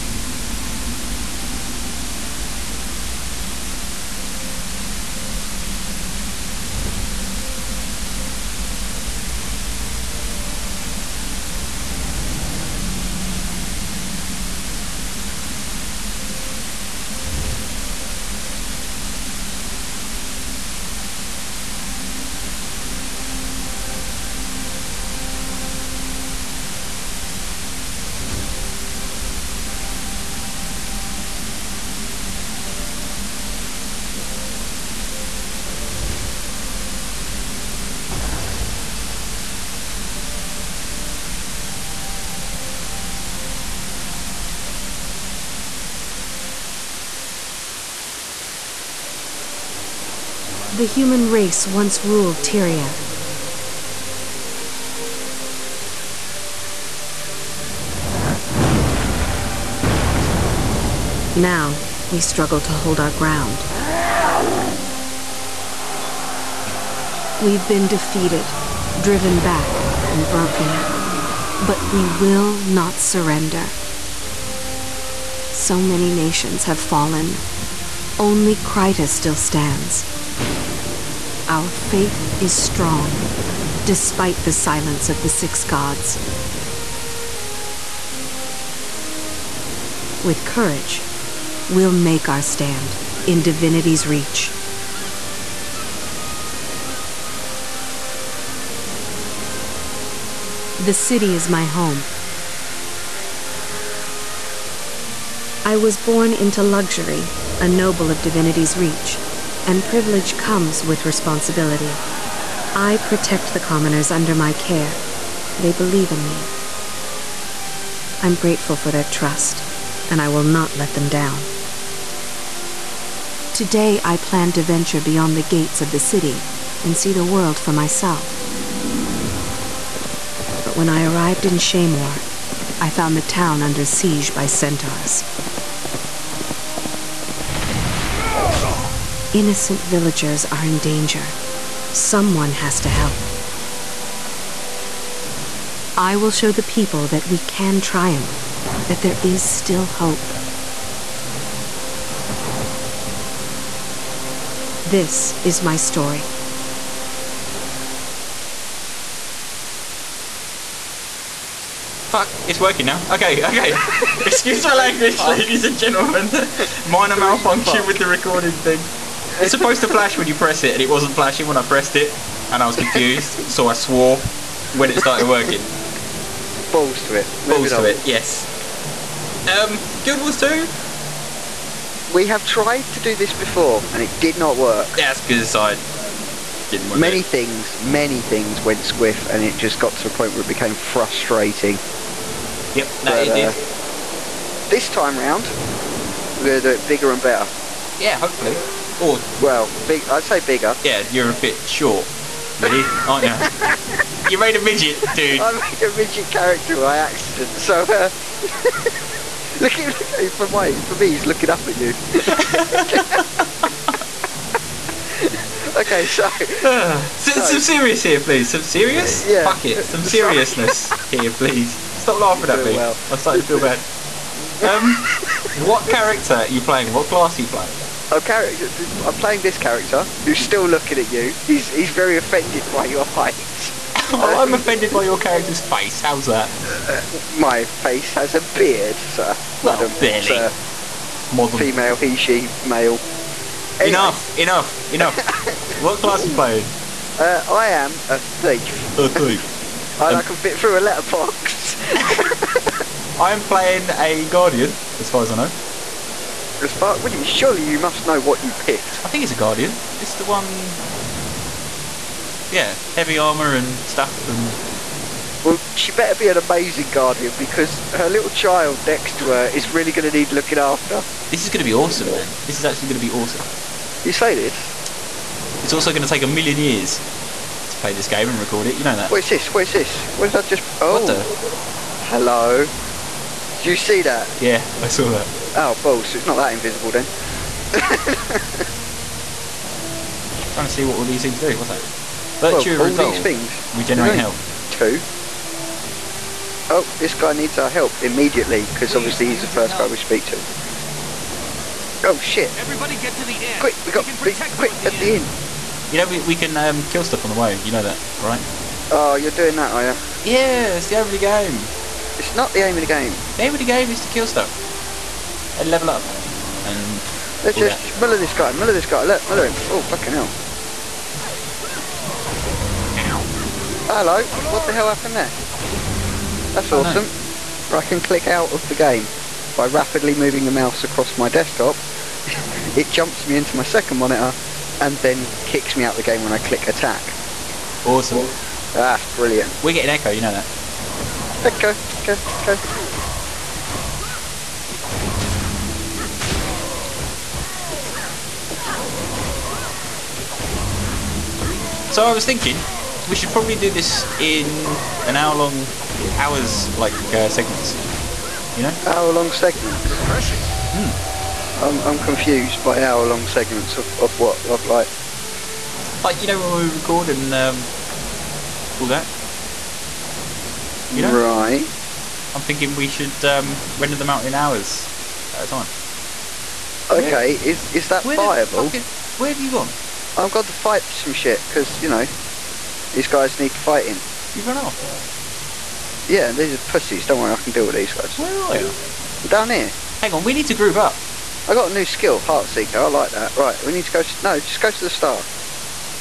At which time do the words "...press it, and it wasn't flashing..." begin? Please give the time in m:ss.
2:50.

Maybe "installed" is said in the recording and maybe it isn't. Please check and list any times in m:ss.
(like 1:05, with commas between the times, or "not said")
not said.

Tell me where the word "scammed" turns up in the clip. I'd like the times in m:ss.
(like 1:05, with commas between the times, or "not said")
not said.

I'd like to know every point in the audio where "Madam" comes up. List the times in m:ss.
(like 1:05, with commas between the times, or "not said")
3:59.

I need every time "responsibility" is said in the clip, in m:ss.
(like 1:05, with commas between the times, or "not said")
1:51.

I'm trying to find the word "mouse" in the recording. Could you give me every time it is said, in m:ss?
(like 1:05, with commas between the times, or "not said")
5:30.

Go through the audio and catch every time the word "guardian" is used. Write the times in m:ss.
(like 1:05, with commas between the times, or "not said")
4:14, 4:19, 4:26.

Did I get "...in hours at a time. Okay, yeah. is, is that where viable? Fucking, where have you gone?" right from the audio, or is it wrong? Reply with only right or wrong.
right.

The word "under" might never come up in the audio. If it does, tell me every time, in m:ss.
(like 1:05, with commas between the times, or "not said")
1:54, 2:13.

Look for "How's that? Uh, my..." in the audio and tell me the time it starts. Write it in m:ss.
3:56.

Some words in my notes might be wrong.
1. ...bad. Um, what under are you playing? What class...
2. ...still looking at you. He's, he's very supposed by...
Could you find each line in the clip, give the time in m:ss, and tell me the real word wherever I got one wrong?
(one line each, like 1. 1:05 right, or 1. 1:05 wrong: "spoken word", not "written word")
1. 3:43 wrong: "character", not "under"
2. 3:50 wrong: "offended", not "supposed".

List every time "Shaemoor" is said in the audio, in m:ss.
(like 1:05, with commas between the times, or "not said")
2:11.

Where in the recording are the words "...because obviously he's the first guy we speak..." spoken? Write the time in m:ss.
4:58.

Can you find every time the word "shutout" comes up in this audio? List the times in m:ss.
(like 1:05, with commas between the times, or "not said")
not said.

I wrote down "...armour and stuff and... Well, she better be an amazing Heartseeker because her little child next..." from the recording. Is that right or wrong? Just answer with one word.
wrong.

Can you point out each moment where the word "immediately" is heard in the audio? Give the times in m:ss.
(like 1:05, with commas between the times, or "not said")
4:58.